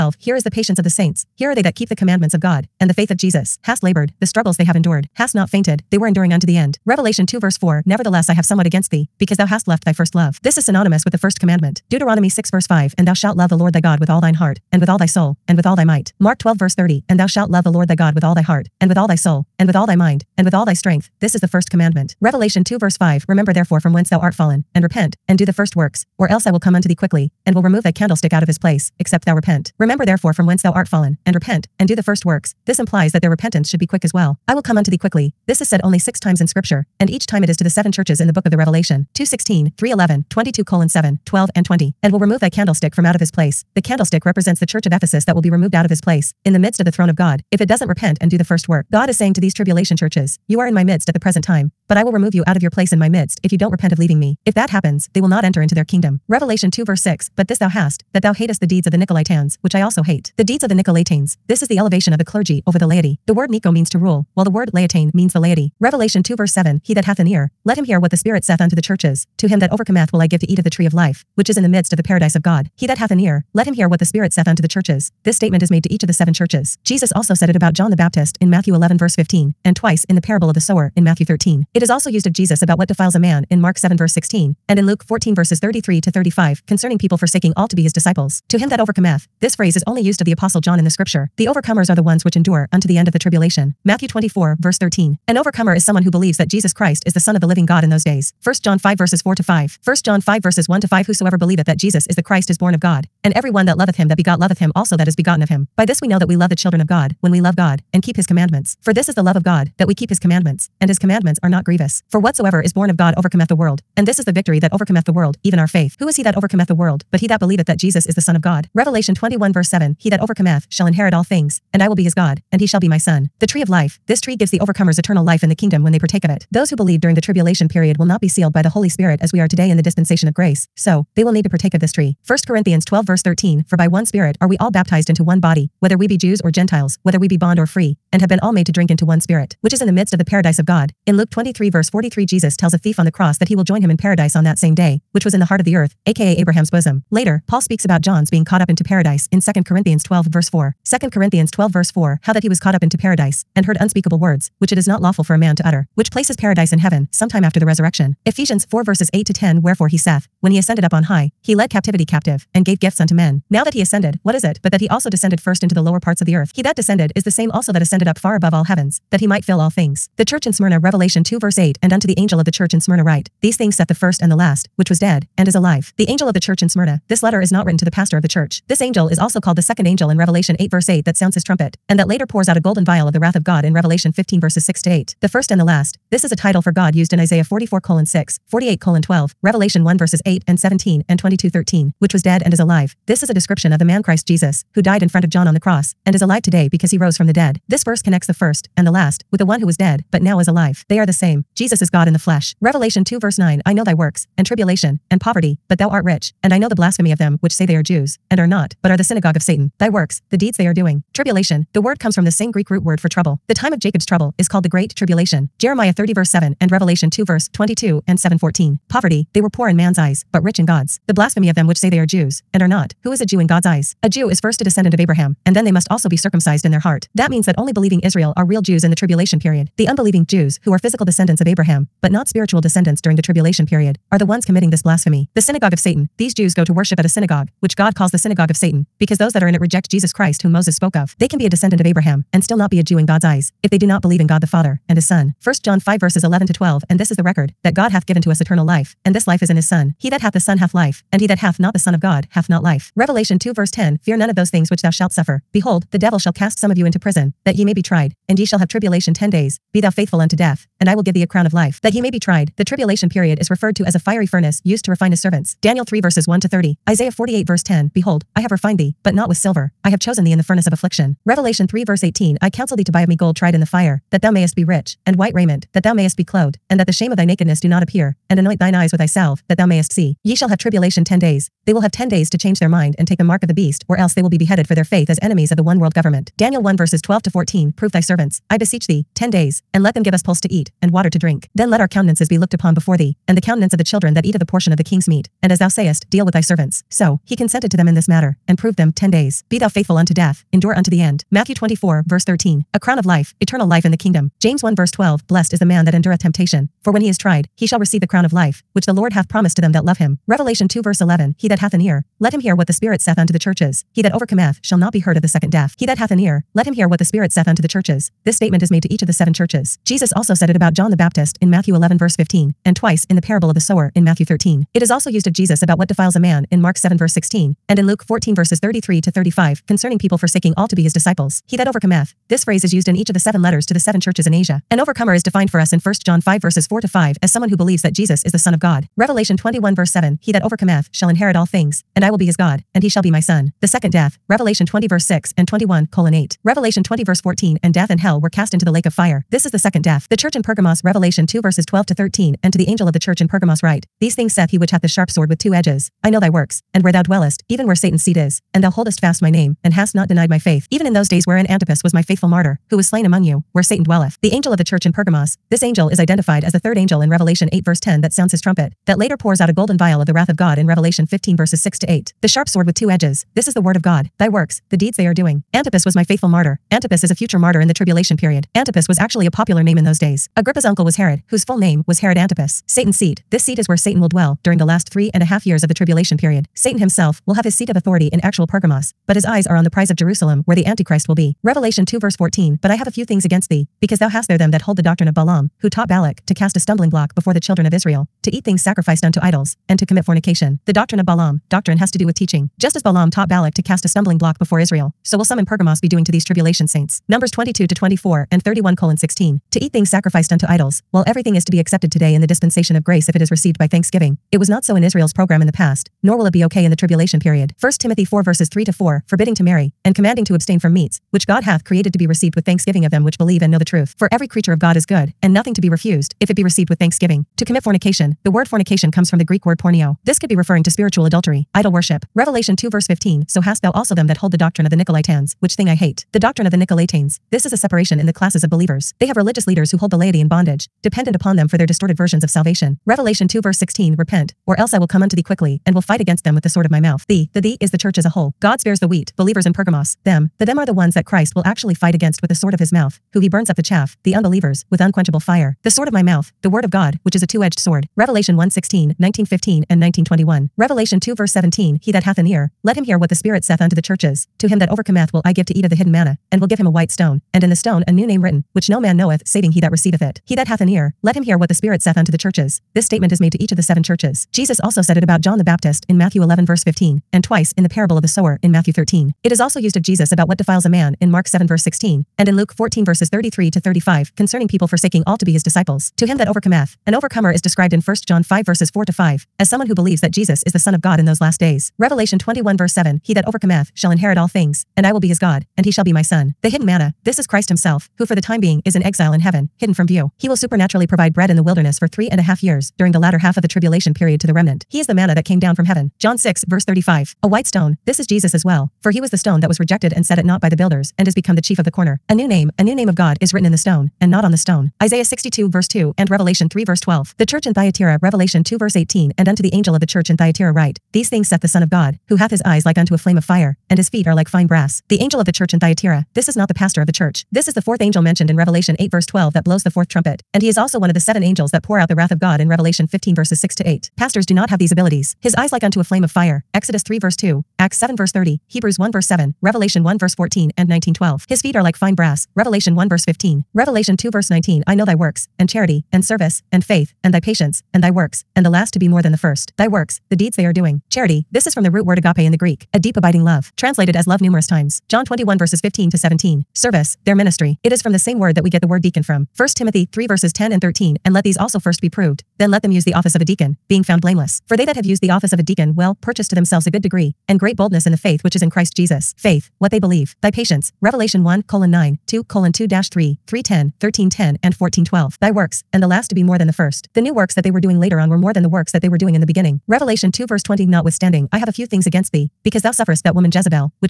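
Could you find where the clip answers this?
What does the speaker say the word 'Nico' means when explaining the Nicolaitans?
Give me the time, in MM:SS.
01:03.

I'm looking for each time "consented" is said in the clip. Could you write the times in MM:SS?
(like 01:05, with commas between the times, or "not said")
04:57.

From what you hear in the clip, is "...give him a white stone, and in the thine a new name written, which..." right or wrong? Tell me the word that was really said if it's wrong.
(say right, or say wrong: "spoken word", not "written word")
wrong: "stone", not "thine".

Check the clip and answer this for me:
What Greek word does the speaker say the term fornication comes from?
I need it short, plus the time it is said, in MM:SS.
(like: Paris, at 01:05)
porneo, at 07:09.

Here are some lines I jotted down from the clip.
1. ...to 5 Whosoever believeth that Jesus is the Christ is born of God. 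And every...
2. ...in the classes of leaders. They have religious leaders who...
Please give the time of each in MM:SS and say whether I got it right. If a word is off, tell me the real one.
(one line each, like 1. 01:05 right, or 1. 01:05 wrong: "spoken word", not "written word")
1. 01:40 right
2. 07:17 wrong: "believers", not "leaders".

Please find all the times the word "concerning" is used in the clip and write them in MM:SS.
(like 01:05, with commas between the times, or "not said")
01:26, 05:29, 08:04.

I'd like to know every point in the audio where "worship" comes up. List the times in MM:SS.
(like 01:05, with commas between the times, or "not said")
03:56, 07:11.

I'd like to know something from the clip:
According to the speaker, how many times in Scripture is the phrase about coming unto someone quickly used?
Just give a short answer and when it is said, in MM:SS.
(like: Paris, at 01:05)
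6, at 00:35.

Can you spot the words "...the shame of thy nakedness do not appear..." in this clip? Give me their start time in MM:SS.
04:36.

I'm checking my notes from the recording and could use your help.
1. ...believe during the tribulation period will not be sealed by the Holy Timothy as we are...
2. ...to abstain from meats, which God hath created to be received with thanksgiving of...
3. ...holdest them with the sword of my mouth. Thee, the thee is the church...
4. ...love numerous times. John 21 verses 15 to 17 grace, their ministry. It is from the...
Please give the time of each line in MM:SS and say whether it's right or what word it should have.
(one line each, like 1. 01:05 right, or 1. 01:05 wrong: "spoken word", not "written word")
1. 02:06 wrong: "Spirit", not "Timothy"
2. 07:00 right
3. 07:25 wrong: "against", not "holdest"
4. 09:14 wrong: "service", not "grace".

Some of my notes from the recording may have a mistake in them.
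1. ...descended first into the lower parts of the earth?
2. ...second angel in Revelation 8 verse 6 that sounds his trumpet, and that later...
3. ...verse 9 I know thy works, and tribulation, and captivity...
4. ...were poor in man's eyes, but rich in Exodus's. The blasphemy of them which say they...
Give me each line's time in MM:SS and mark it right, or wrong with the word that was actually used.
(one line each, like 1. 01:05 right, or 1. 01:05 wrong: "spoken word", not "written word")
1. 02:45 right
2. 02:59 wrong: "8", not "6"
3. 03:23 wrong: "poverty", not "captivity"
4. 03:39 wrong: "God", not "Exodus".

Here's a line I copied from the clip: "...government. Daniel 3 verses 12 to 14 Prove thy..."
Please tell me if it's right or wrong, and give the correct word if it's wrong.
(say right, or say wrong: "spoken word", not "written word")
wrong: "1", not "3".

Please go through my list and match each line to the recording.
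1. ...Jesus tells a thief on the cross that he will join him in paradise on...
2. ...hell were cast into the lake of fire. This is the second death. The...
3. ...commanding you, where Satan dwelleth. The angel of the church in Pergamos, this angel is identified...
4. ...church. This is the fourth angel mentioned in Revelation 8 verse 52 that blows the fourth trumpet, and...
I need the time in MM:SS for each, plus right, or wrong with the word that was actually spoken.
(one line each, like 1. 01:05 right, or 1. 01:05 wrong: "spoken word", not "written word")
1. 02:22 right
2. 05:47 right
3. 06:03 wrong: "among", not "commanding"
4. 08:46 wrong: "12", not "52".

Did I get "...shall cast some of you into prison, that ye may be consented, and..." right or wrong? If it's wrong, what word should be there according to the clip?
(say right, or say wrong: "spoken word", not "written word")
wrong: "tried", not "consented".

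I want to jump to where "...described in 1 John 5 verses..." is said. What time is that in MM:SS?
08:07.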